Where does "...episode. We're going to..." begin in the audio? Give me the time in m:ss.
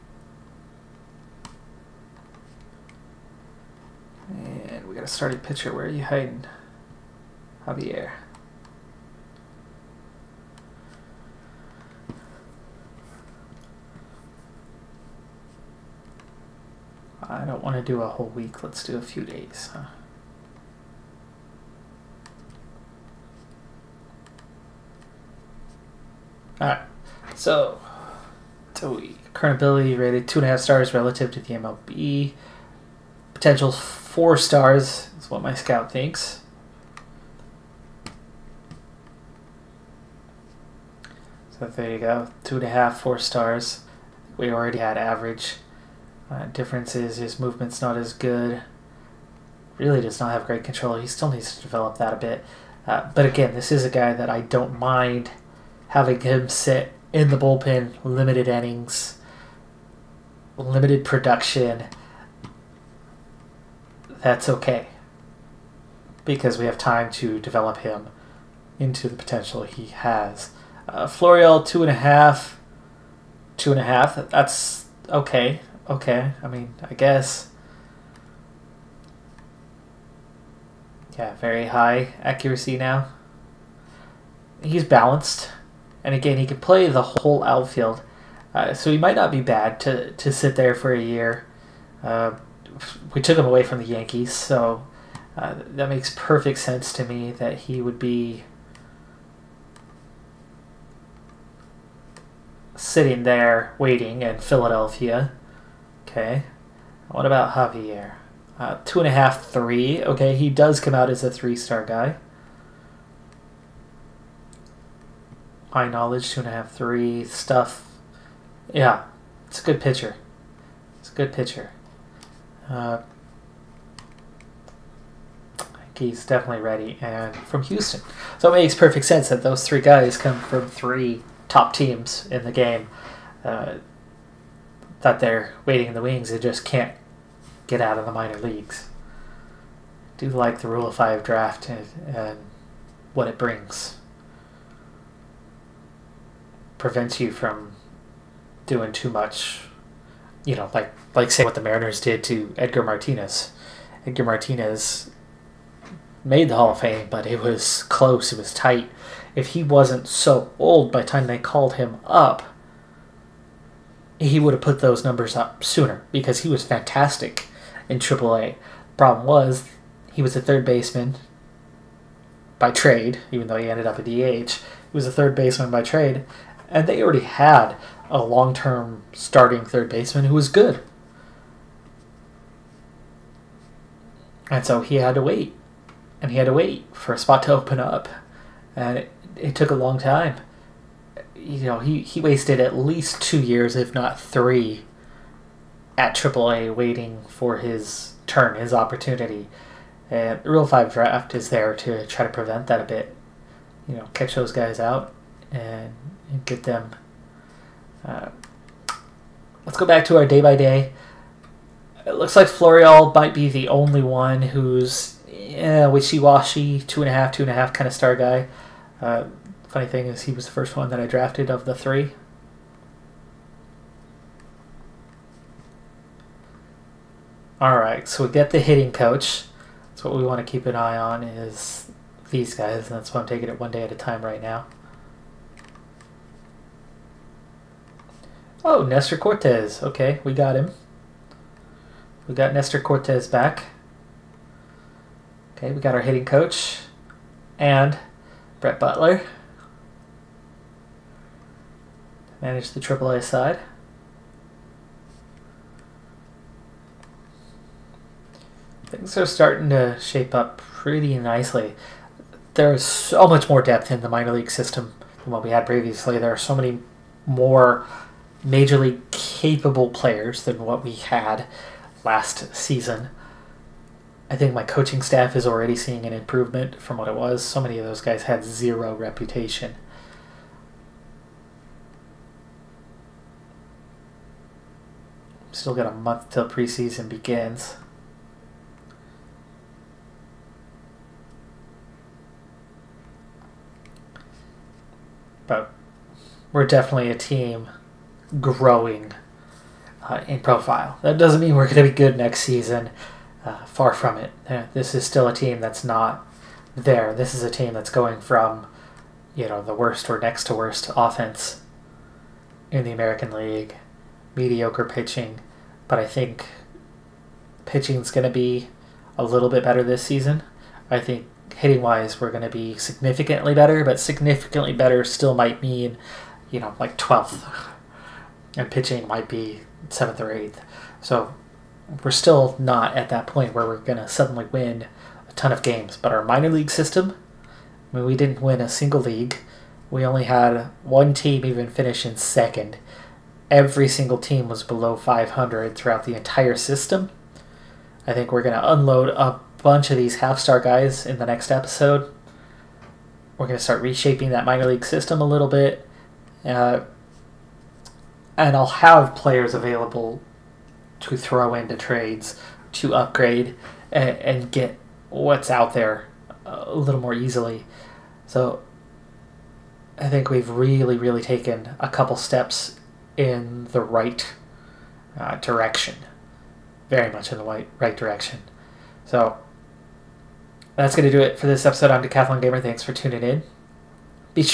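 5:51.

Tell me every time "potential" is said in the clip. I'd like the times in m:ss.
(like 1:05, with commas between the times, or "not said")
0:33, 1:09.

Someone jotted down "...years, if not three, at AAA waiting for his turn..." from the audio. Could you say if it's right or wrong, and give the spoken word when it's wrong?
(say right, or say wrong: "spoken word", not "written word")
right.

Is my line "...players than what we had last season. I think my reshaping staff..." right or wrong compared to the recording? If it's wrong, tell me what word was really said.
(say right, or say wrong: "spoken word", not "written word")
wrong: "coaching", not "reshaping".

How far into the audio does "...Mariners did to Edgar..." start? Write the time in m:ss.
2:31.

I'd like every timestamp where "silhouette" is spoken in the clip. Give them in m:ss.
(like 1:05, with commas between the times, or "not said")
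not said.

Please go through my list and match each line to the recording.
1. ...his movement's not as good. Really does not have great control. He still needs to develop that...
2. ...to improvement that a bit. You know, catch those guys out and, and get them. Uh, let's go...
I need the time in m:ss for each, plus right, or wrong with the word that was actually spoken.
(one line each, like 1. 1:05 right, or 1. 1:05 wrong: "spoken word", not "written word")
1. 0:47 right
2. 3:22 wrong: "prevent", not "improvement".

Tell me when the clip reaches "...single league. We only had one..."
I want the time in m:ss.
5:38.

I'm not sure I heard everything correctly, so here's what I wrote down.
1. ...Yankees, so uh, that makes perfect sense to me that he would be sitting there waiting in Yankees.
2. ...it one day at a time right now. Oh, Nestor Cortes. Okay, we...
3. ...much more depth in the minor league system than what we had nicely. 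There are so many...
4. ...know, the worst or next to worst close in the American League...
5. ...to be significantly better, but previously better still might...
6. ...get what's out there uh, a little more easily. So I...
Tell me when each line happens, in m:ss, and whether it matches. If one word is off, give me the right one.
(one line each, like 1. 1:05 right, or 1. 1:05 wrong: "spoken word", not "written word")
1. 1:33 wrong: "Philadelphia", not "Yankees"
2. 3:53 right
3. 4:23 wrong: "previously", not "nicely"
4. 5:09 wrong: "offense", not "close"
5. 5:22 wrong: "significantly", not "previously"
6. 6:04 right.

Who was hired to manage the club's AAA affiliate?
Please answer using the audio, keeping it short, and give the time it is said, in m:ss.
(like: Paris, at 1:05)
Brett Butler, at 4:08.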